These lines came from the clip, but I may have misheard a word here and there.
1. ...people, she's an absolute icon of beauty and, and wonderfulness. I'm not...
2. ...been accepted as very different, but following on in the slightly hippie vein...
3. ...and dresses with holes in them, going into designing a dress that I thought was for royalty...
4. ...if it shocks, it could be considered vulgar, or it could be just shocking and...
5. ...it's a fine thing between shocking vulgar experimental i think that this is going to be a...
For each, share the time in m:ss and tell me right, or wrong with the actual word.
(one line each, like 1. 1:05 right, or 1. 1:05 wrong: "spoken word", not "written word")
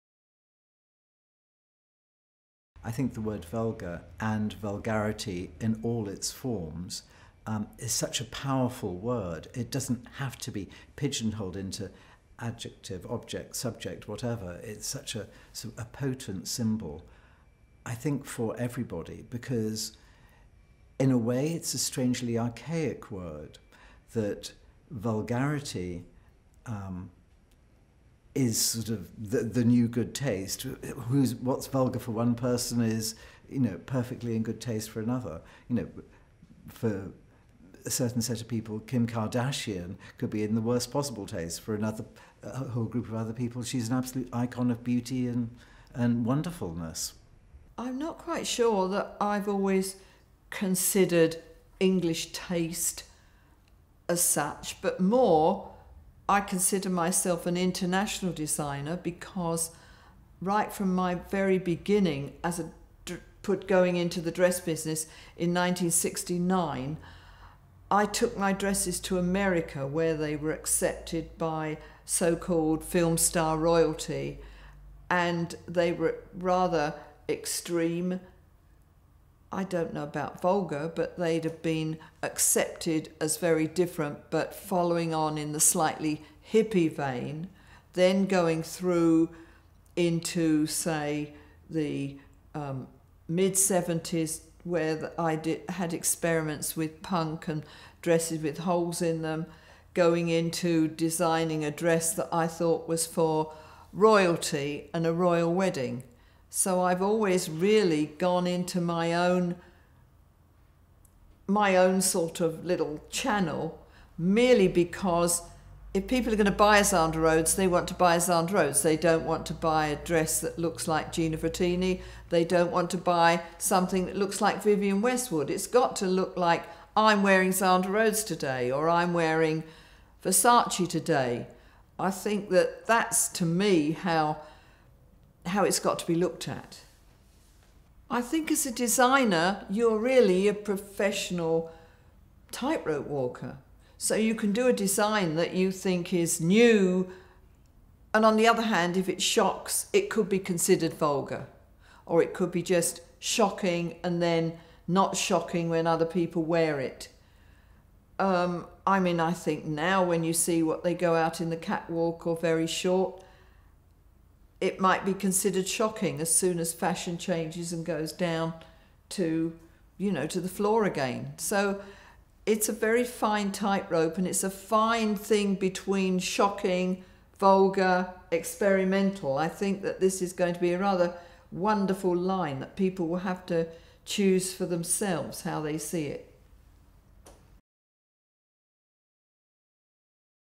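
1. 0:43 right
2. 1:21 right
3. 1:37 right
4. 2:28 right
5. 2:54 right.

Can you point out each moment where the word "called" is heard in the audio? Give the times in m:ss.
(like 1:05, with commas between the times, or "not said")
1:12.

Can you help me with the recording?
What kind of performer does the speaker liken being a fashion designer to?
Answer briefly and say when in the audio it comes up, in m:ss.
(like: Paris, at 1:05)
professional tightrope walker, at 2:20.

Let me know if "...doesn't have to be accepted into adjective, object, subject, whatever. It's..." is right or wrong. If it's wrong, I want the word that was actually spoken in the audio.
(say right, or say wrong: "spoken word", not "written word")
wrong: "pigeonholed", not "accepted".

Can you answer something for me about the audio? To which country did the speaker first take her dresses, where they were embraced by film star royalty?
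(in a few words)
America.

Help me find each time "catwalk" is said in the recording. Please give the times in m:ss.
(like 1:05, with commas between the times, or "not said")
2:41.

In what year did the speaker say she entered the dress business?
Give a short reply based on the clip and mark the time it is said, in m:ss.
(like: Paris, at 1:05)
1969, at 1:05.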